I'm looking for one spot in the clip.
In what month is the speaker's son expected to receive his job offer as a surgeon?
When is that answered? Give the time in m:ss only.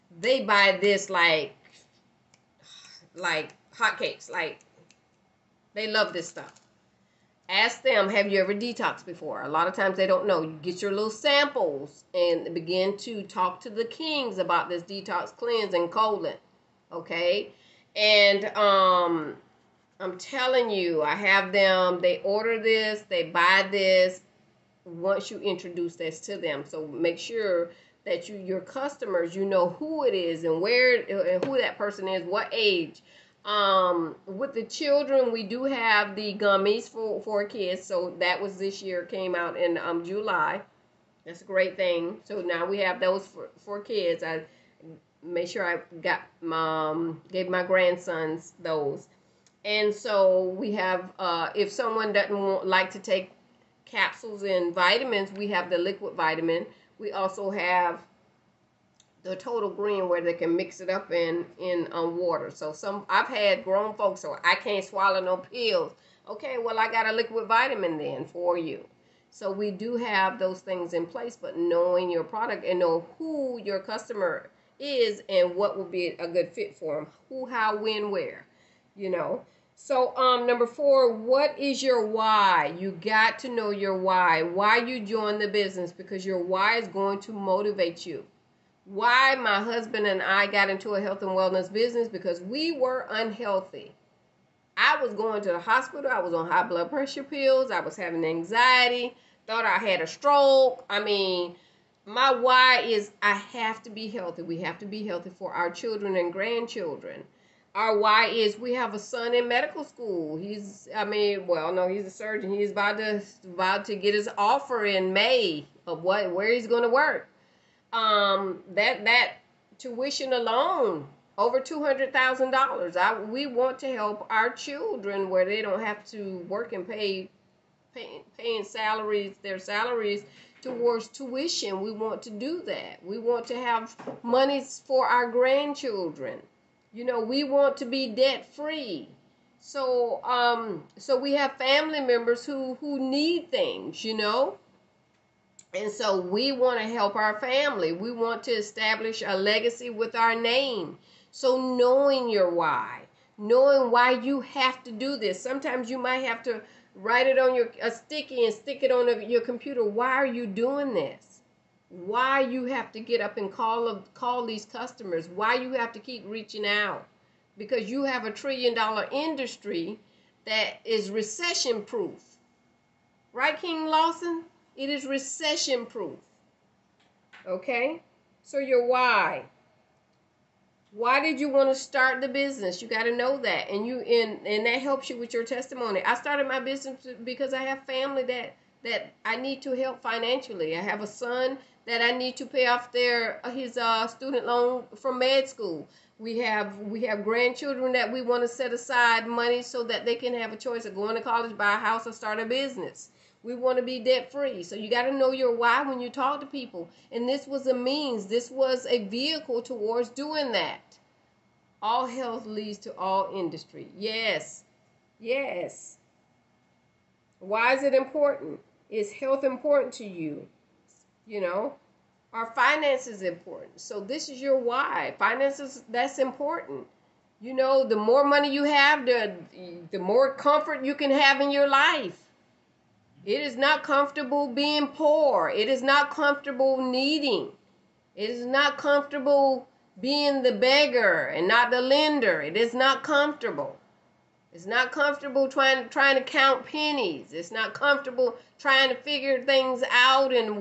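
1:55.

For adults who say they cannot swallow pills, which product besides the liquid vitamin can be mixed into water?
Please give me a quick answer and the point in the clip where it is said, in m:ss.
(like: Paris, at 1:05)
total green, at 0:59.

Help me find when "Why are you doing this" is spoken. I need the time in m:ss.
2:39.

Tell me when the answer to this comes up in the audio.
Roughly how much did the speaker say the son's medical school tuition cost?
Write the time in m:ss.
2:01.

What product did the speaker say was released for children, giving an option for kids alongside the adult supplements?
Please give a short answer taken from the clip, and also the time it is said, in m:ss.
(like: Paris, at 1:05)
gummies, at 0:36.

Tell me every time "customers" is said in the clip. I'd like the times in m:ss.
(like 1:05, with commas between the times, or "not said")
0:28, 1:13, 2:44.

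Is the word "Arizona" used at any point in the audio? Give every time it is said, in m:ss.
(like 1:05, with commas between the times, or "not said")
not said.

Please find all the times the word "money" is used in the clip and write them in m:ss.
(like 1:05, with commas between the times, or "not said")
3:19, 3:48.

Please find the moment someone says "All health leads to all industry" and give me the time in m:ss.
3:31.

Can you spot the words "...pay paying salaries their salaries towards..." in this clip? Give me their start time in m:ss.
2:07.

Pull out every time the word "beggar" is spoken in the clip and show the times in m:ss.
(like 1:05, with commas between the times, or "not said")
4:00.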